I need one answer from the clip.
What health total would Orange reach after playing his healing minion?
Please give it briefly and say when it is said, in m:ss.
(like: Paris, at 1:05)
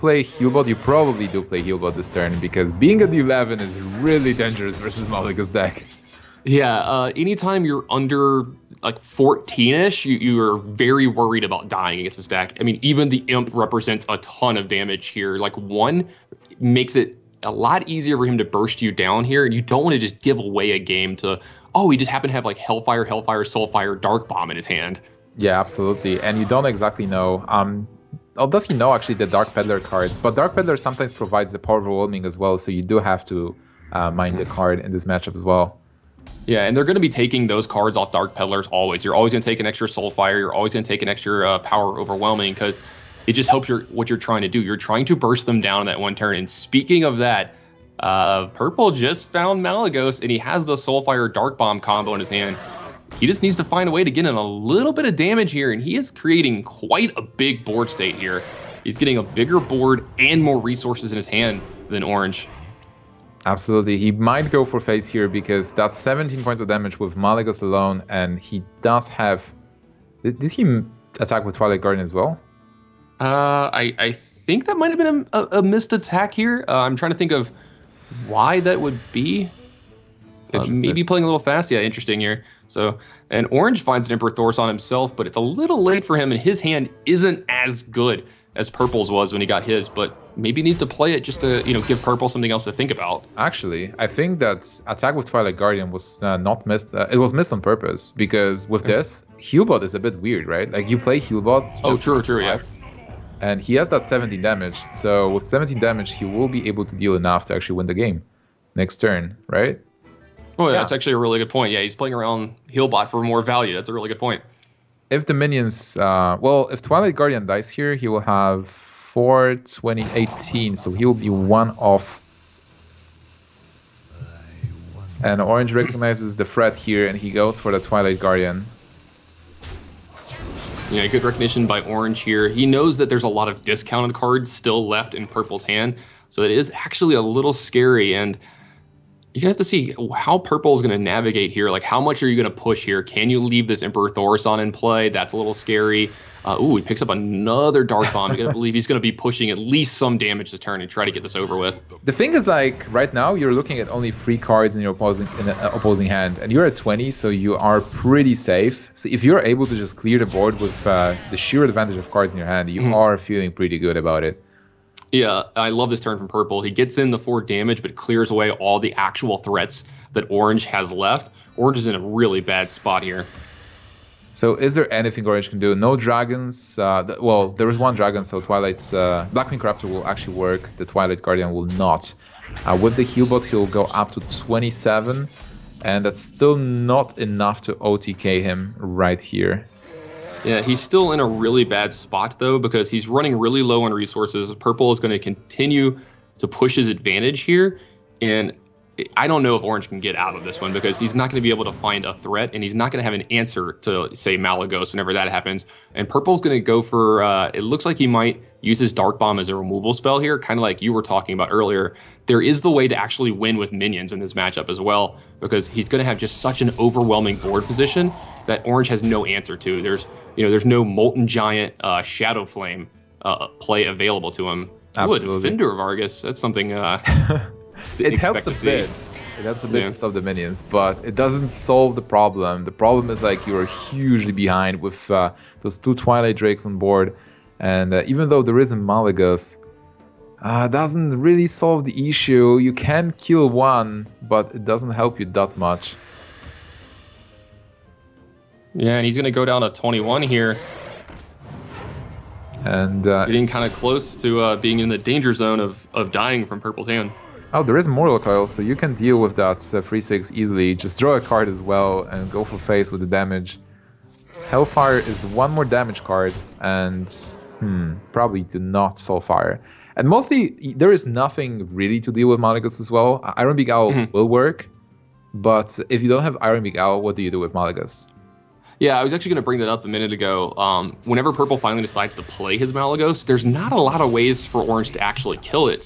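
27, at 3:04.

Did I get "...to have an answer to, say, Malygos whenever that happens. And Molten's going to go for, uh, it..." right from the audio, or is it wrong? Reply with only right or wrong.
wrong.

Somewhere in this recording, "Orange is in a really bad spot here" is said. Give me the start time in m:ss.
2:51.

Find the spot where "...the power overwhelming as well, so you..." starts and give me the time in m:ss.
0:31.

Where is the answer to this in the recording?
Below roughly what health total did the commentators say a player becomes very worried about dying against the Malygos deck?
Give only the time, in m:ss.
0:08.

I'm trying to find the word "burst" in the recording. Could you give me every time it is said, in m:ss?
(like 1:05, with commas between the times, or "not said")
0:18, 0:45.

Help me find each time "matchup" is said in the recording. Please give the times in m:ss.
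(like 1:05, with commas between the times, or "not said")
0:35, 3:34.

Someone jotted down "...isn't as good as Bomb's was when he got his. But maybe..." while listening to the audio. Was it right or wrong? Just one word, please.
wrong.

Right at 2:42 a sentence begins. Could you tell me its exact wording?
are feeling pretty good about it.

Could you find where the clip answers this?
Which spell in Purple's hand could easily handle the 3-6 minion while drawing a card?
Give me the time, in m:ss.
4:17.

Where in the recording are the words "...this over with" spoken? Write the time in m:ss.
2:31.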